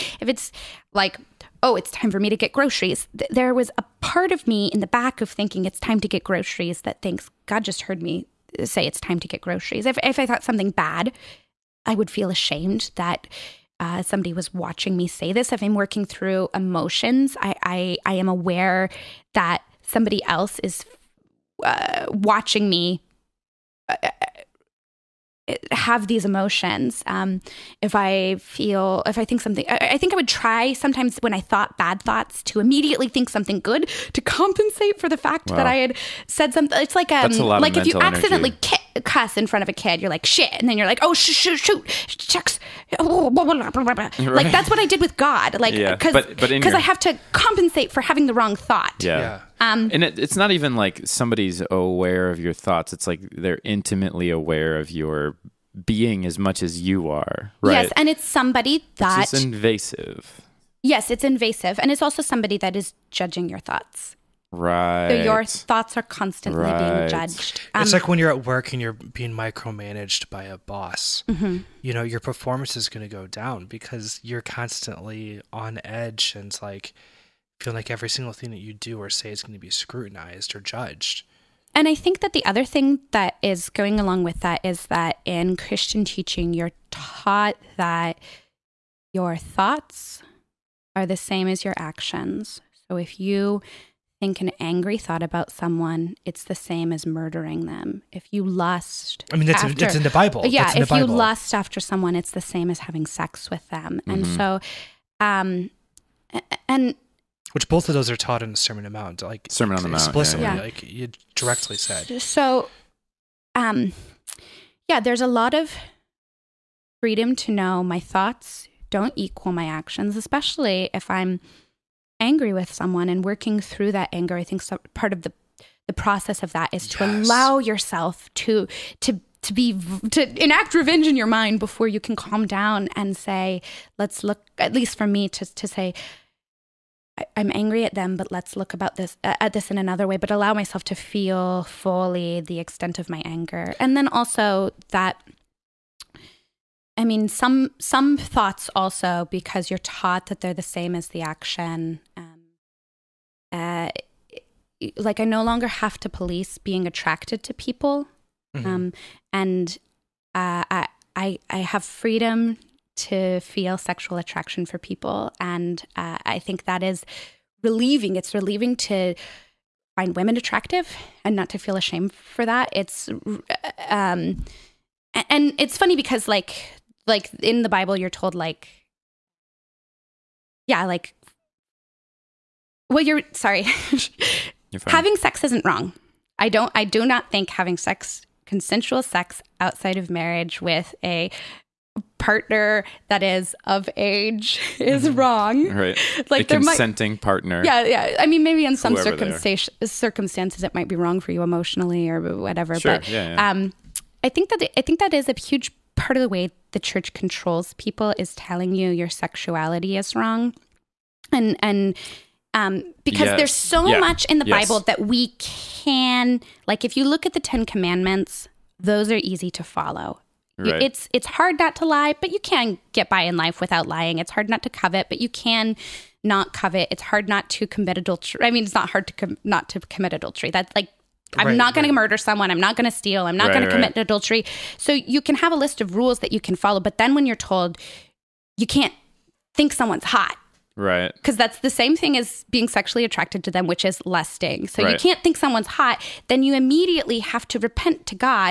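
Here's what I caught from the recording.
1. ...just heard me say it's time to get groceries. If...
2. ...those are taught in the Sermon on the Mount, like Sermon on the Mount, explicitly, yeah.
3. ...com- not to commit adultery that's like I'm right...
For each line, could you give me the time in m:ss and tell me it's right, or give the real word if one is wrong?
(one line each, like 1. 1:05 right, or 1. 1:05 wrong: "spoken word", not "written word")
1. 0:07 right
2. 1:47 right
3. 3:49 right.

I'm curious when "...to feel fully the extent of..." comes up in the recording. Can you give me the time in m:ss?
2:20.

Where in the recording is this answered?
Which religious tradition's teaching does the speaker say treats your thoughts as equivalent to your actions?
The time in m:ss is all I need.
1:25.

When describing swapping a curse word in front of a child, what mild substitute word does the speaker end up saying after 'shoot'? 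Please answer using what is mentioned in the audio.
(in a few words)
shucks.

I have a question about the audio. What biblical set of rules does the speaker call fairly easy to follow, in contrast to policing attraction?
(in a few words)
10 commandments.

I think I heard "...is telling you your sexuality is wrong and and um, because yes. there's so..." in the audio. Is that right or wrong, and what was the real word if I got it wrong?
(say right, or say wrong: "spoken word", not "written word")
right.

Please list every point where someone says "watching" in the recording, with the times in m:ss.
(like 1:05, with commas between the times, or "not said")
0:14, 0:22.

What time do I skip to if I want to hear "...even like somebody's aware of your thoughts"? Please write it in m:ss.
0:50.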